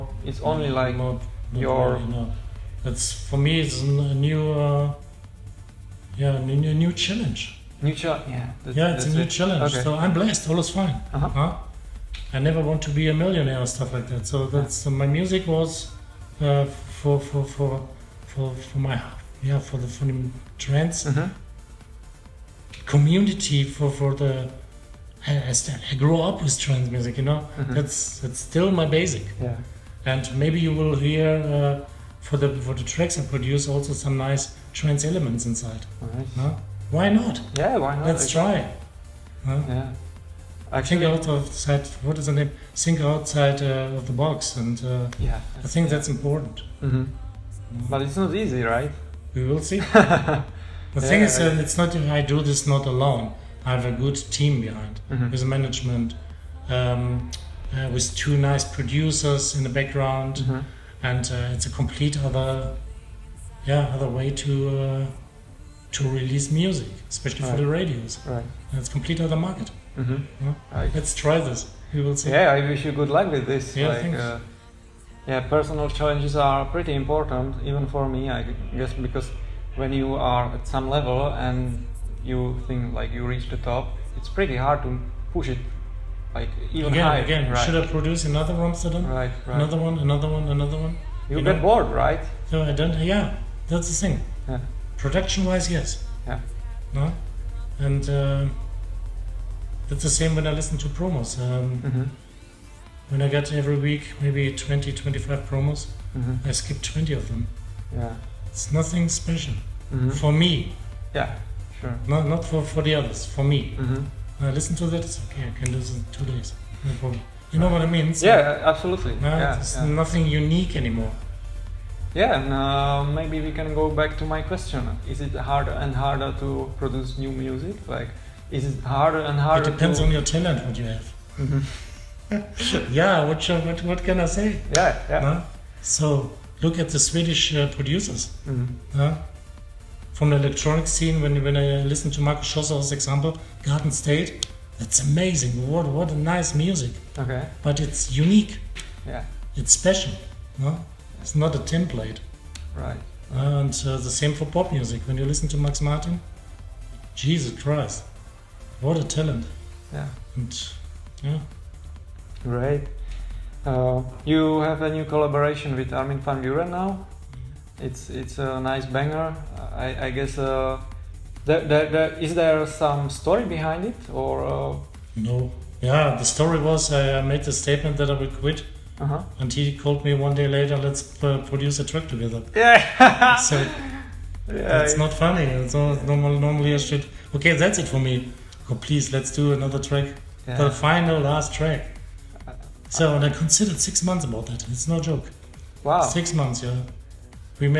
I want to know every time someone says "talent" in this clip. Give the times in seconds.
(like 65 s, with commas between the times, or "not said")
130 s, 159 s.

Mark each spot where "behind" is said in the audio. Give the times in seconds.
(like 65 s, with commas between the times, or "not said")
54 s, 173 s.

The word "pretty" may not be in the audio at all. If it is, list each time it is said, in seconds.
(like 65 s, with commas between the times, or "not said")
76 s, 84 s.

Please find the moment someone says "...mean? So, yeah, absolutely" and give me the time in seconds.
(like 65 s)
117 s.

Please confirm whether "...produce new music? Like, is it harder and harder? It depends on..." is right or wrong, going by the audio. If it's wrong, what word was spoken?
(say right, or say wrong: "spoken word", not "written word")
right.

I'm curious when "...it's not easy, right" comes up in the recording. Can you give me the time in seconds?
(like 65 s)
48 s.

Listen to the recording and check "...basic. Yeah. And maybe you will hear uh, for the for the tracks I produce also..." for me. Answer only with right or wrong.
right.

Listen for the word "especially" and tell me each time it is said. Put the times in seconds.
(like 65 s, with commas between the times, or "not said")
67 s.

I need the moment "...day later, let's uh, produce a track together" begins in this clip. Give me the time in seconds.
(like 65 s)
180 s.